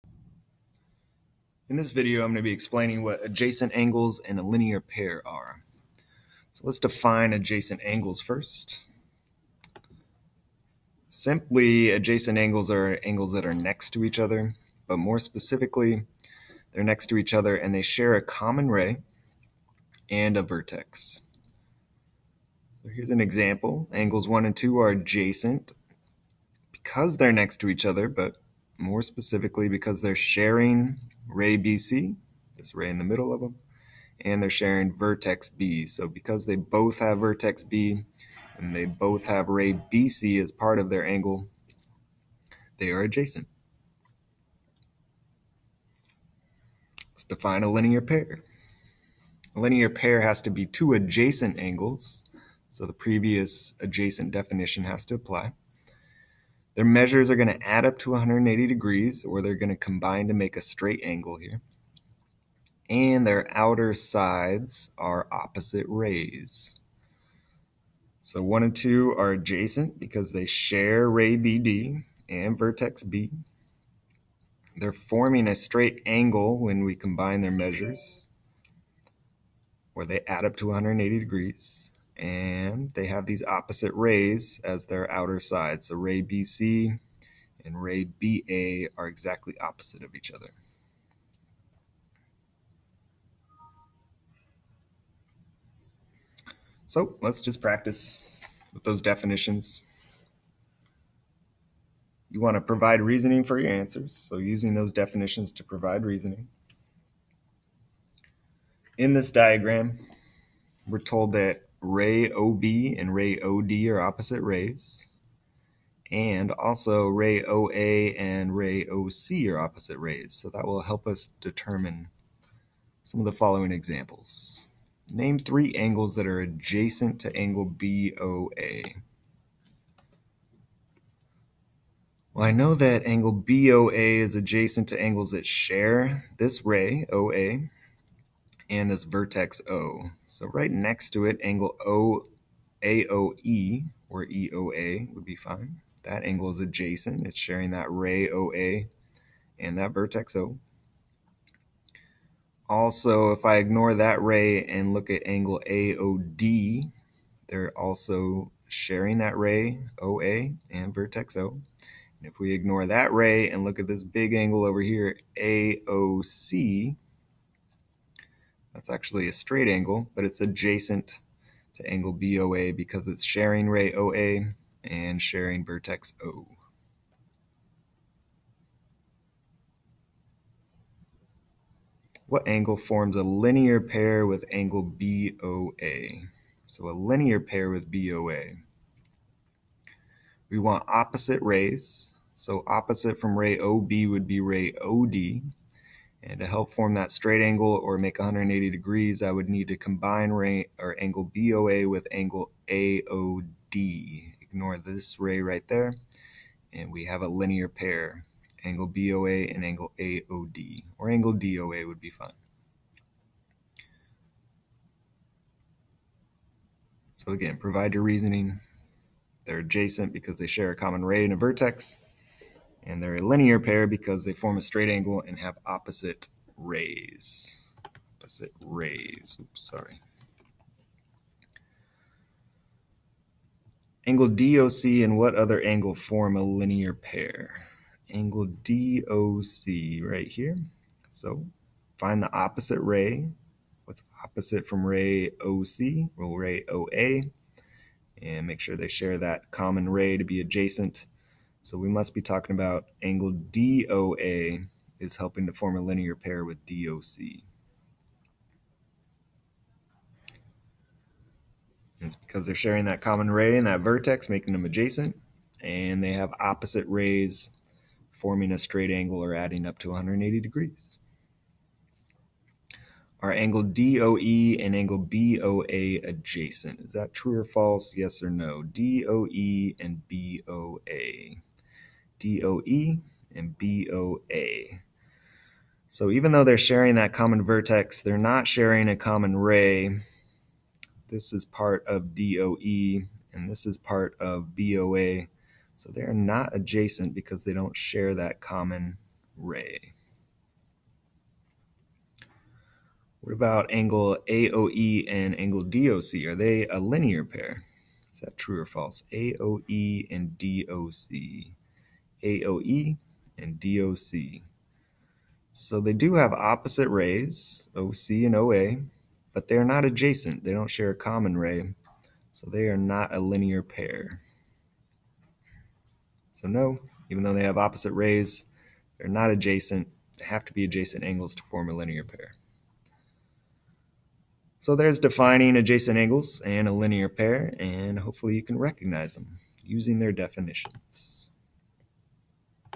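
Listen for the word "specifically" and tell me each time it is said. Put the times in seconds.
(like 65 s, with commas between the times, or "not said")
15 s, 29 s.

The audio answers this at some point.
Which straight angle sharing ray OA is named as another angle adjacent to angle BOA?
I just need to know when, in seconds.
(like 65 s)
165 s.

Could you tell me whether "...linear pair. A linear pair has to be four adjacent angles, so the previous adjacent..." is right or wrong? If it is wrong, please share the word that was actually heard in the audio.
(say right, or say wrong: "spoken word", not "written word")
wrong: "two", not "four".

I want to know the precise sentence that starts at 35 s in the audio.
So because they both have vertex B and they both have ray BC as part of their angle, they are adjacent.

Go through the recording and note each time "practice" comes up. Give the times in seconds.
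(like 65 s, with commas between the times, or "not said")
97 s.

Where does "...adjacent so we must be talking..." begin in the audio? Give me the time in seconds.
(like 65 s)
250 s.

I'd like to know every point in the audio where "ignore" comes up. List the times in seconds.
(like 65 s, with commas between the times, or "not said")
153 s, 162 s, 204 s.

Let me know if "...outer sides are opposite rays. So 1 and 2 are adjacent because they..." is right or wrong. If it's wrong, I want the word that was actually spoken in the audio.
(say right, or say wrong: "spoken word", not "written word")
right.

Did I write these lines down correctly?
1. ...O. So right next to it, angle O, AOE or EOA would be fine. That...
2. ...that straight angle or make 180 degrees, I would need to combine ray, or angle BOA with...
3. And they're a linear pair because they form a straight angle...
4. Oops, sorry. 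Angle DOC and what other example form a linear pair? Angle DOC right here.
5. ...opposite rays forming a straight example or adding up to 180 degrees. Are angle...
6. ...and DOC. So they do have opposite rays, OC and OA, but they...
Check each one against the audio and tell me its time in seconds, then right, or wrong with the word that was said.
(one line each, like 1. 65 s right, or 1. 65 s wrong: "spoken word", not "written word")
1. 139 s right
2. 196 s right
3. 222 s right
4. 229 s wrong: "angle", not "example"
5. 266 s wrong: "angle", not "example"
6. 313 s right.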